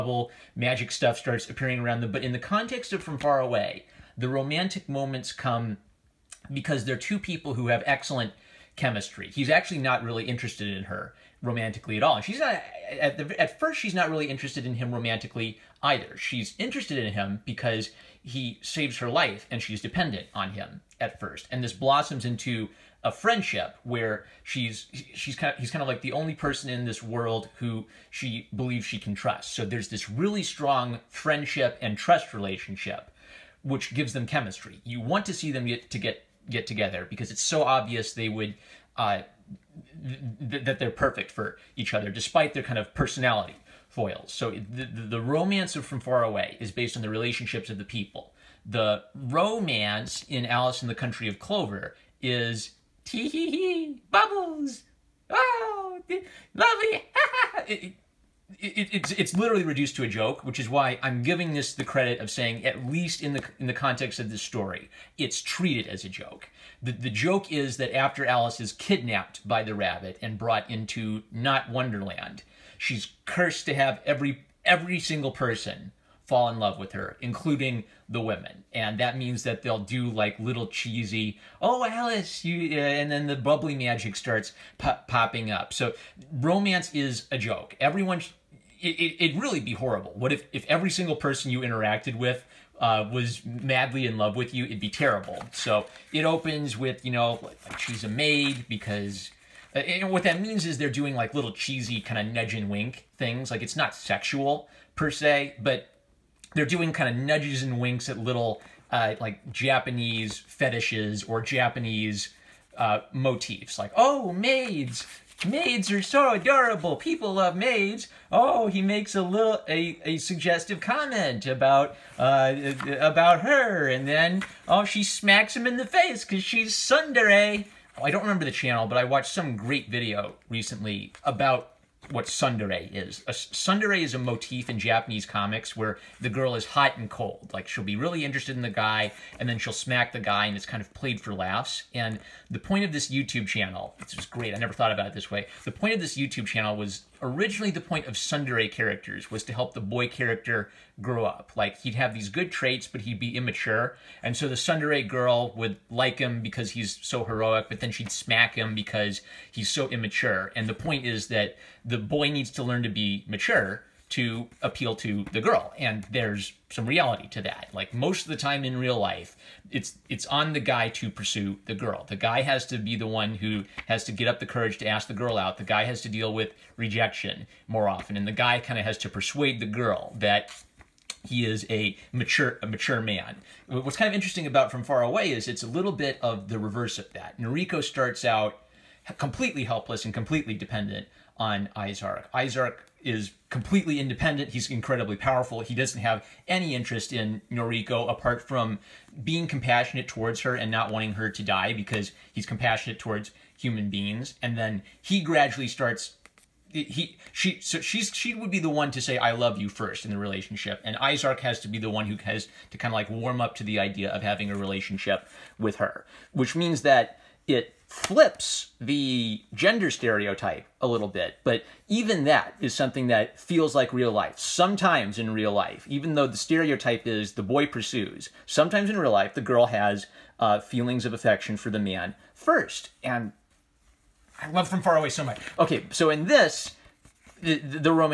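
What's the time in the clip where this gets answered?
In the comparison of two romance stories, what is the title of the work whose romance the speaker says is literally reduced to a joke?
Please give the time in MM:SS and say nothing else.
00:50.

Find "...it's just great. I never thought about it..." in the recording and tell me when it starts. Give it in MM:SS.
02:23.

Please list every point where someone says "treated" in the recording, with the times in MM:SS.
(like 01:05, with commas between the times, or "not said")
01:05.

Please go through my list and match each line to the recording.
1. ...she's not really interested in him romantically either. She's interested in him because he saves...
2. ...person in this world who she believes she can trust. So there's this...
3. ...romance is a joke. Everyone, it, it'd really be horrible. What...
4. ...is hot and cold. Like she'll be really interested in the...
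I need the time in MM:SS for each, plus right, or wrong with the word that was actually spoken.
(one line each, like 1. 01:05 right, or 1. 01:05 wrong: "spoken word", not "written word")
1. 00:13 right
2. 00:26 right
3. 01:26 right
4. 02:16 right.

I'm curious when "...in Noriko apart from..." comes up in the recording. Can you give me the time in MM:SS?
03:17.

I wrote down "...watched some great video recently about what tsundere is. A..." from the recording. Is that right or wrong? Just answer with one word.
right.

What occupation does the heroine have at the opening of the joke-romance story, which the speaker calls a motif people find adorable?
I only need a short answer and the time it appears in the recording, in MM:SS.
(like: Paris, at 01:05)
Maid, at 01:37.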